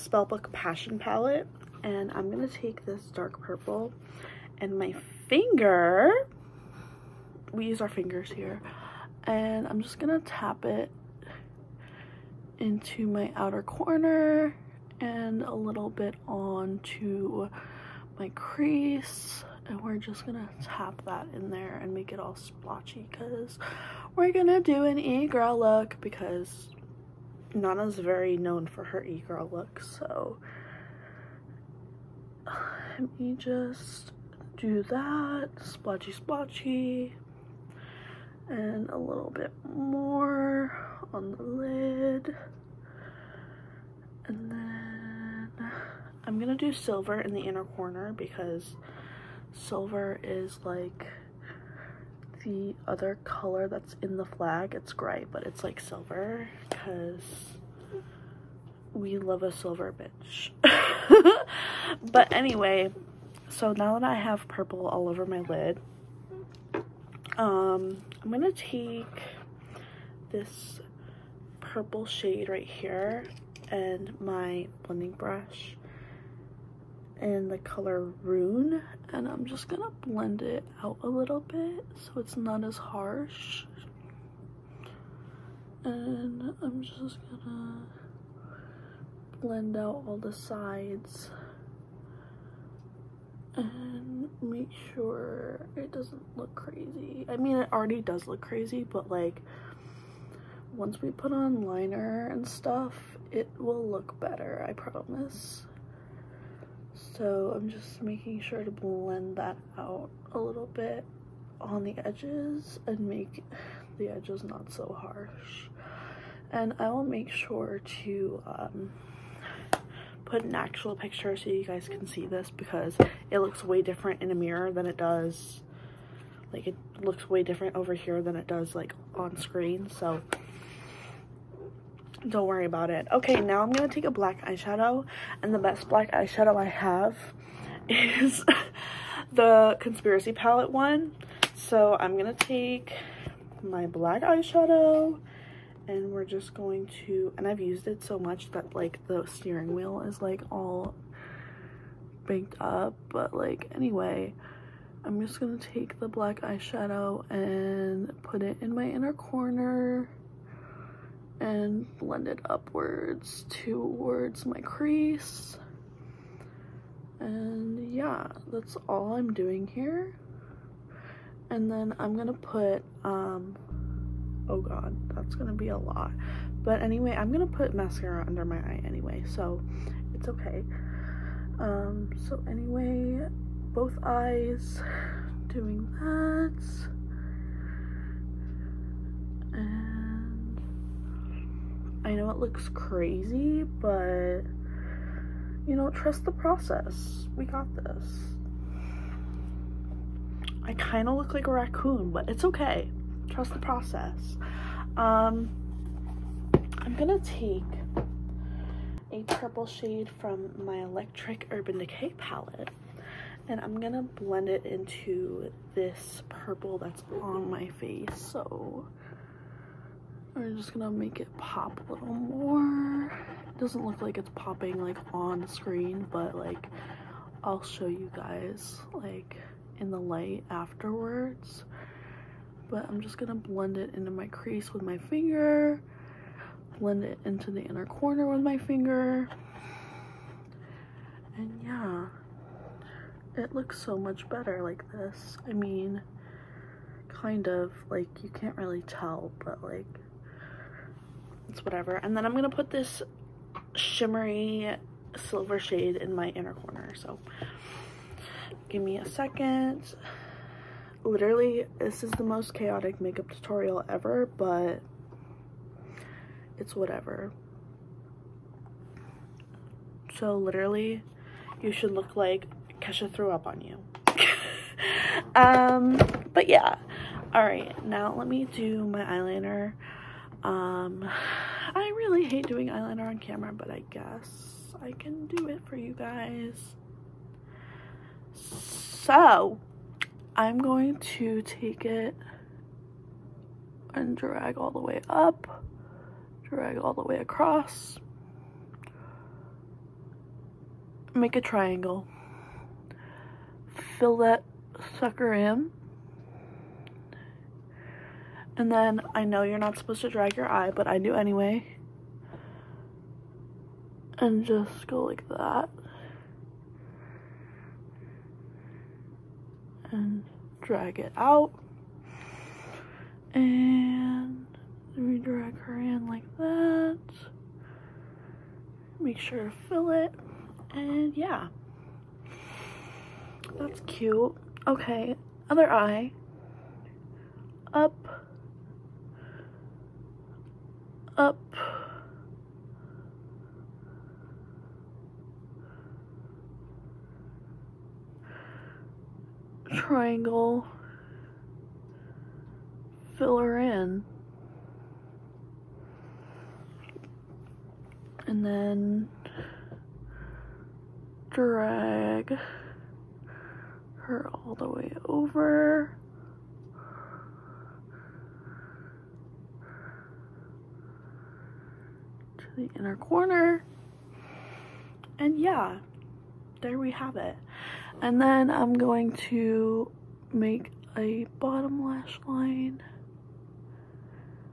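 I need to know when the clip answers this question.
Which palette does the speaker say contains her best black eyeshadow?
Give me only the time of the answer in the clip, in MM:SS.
02:19.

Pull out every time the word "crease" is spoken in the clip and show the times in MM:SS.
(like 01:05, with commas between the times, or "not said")
00:18, 02:44, 03:54.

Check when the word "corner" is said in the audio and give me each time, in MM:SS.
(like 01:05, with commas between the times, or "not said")
00:13, 00:47, 02:39, 03:57, 04:16, 06:12.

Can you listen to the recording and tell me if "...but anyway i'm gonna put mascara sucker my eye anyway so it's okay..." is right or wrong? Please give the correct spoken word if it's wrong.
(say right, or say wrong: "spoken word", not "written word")
wrong: "under", not "sucker".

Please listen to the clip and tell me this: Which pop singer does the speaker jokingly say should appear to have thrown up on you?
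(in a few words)
Kesha.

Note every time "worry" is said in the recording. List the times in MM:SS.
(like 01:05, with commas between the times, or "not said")
02:12.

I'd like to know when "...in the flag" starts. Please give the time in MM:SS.
00:54.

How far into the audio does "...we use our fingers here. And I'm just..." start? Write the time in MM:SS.
00:07.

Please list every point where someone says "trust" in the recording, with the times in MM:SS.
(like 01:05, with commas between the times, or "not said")
03:15, 03:23.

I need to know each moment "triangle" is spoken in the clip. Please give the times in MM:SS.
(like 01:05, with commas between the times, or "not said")
05:01, 05:49.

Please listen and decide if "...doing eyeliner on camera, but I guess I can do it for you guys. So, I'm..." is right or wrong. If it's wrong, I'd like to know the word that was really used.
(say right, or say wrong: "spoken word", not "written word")
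right.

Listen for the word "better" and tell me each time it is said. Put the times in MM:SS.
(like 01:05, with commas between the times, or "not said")
01:44, 04:04.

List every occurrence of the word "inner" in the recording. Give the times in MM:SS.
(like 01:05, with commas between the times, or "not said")
00:47, 02:38, 03:57, 04:16, 06:12.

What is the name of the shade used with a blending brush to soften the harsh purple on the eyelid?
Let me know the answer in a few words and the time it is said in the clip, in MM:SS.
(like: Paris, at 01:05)
Rune, at 01:18.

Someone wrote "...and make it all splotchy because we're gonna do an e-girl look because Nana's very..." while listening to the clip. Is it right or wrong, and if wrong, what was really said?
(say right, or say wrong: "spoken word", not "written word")
right.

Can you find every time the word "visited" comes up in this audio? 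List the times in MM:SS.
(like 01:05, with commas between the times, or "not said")
not said.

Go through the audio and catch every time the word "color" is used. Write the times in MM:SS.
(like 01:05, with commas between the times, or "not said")
00:53, 01:17.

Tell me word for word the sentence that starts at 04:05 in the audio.
I mean, kind of, like you can't really tell, but like, it's whatever.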